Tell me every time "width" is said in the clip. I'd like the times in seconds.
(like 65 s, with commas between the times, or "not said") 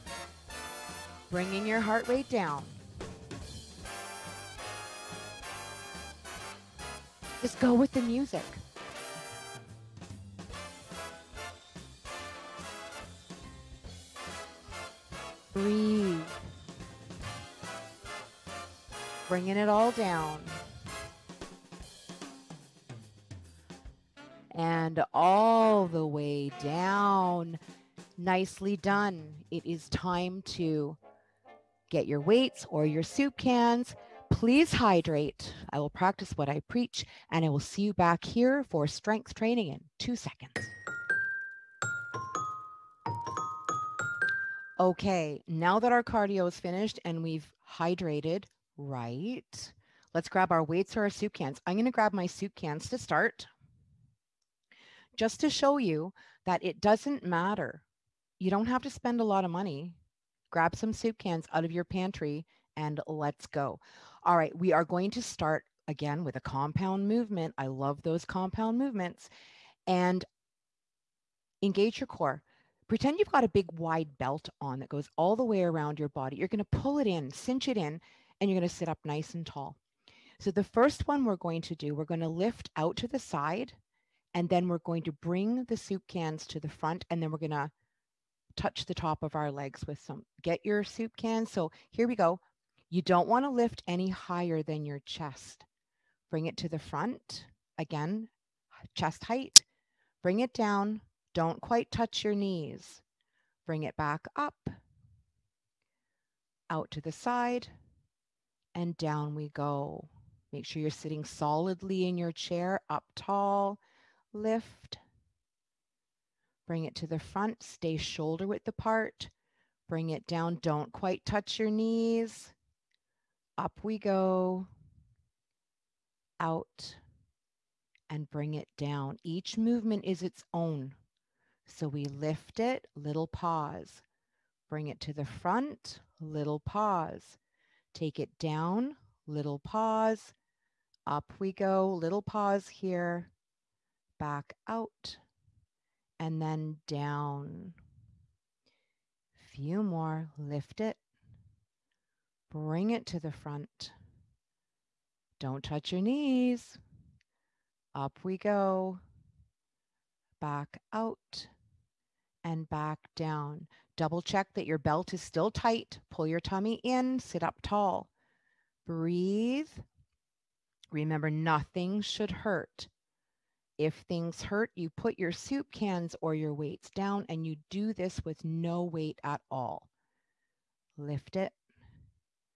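118 s.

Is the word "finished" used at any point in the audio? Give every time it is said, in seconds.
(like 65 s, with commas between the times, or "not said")
46 s.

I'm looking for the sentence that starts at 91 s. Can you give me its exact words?
So here we go, you don't want to lift any higher than your chest.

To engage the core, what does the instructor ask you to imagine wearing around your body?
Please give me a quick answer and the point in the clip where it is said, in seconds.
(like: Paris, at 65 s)
Big wide belt, at 73 s.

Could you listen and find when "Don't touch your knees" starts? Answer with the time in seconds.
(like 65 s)
155 s.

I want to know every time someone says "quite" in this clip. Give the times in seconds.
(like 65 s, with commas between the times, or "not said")
101 s, 120 s.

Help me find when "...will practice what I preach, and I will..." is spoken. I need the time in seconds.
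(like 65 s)
35 s.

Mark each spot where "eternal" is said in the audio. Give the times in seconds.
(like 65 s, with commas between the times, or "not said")
not said.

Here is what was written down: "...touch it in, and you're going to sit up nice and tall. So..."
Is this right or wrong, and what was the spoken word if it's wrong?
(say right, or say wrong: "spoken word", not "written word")
wrong: "cinch", not "touch".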